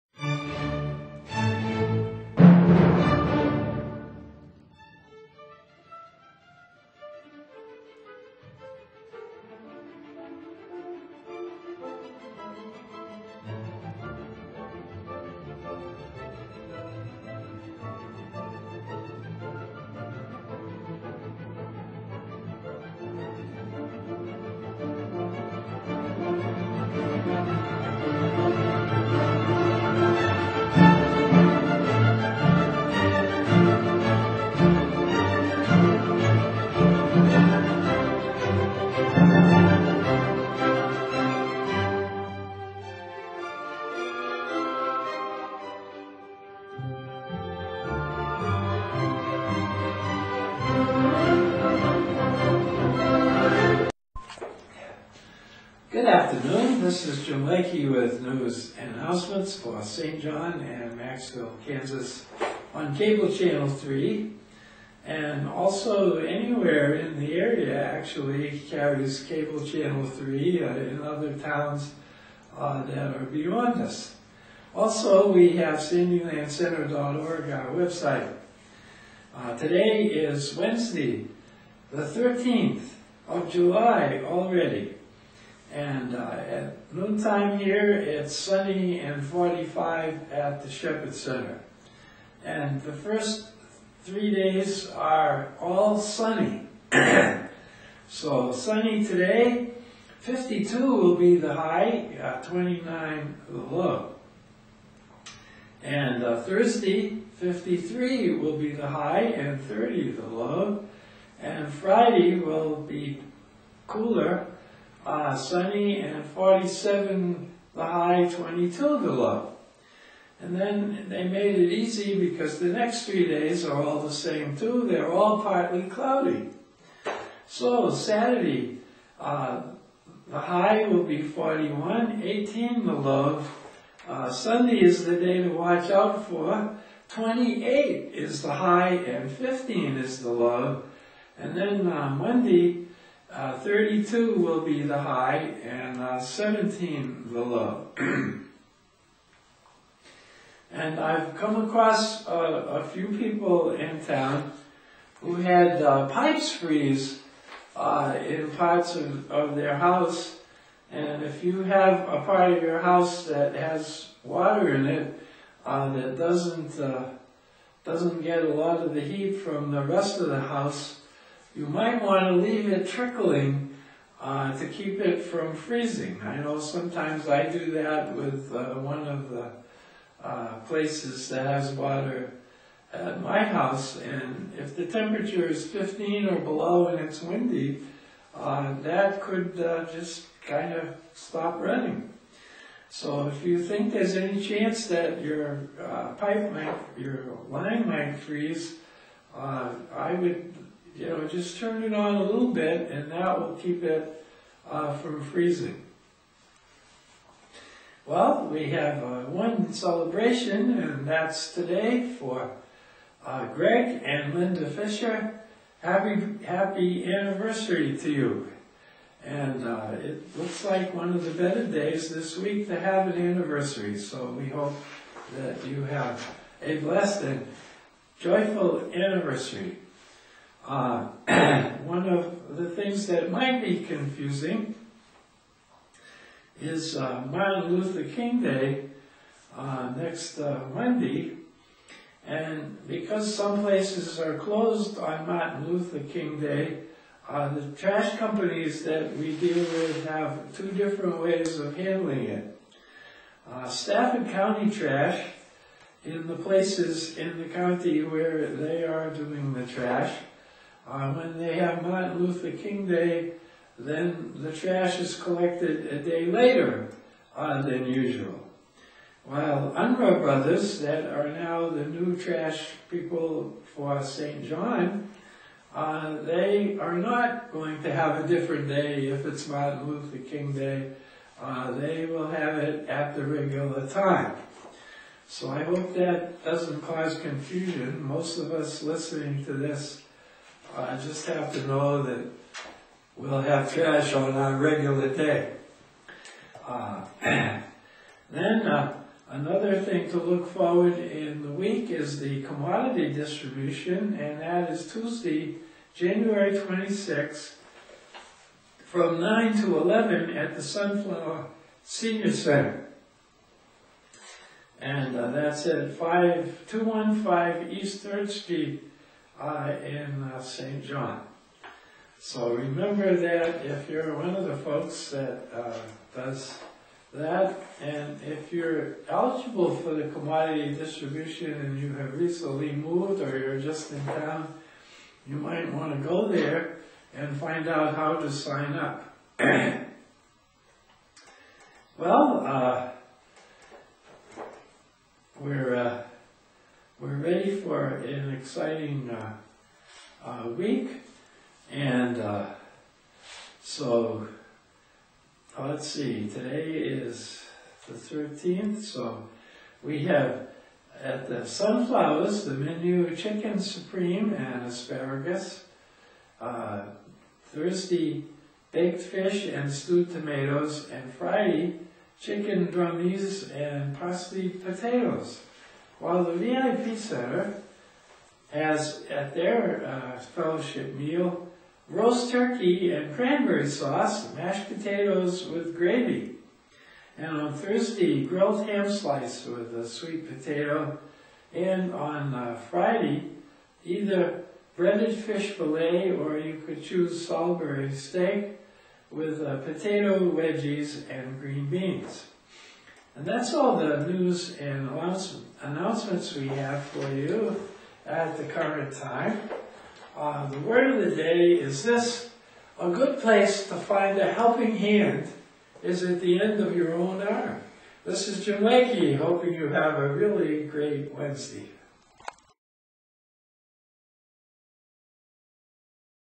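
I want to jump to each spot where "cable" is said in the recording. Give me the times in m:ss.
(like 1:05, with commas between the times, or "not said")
1:02, 1:09.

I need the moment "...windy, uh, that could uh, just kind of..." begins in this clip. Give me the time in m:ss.
3:07.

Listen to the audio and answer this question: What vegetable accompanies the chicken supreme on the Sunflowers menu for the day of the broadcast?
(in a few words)
Asparagus.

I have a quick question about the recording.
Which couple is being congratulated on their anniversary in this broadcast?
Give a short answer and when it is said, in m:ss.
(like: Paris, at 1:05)
Greg and Linda Fisher, at 3:33.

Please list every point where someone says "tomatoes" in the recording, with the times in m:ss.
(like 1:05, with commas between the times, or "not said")
6:10.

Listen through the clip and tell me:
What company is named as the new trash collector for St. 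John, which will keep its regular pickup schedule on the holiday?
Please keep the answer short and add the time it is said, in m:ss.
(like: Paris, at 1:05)
Unruh brothers, at 4:29.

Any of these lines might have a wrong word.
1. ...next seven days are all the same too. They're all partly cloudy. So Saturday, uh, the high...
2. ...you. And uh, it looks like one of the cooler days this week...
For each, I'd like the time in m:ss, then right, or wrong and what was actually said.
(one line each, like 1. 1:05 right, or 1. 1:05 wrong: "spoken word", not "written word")
1. 2:02 wrong: "three", not "seven"
2. 3:38 wrong: "better", not "cooler".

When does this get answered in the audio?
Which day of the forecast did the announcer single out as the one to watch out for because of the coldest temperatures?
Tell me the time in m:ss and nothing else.
2:14.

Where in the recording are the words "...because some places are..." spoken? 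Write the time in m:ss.
4:02.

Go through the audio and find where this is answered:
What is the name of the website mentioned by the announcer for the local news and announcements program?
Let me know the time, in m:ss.
1:15.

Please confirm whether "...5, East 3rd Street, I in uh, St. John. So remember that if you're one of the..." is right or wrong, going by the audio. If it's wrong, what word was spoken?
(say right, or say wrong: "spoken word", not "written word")
right.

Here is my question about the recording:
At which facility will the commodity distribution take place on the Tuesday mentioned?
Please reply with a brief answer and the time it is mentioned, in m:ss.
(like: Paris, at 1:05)
Sunflower Senior Center, at 5:10.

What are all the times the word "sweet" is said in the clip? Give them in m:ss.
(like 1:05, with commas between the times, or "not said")
6:29.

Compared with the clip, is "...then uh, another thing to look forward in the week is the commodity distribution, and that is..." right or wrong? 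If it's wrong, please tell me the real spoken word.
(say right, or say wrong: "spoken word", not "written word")
right.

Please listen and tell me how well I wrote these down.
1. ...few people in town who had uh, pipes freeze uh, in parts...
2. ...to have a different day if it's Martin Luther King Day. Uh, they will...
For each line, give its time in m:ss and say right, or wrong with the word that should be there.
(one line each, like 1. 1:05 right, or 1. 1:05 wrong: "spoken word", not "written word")
1. 2:32 right
2. 4:37 right.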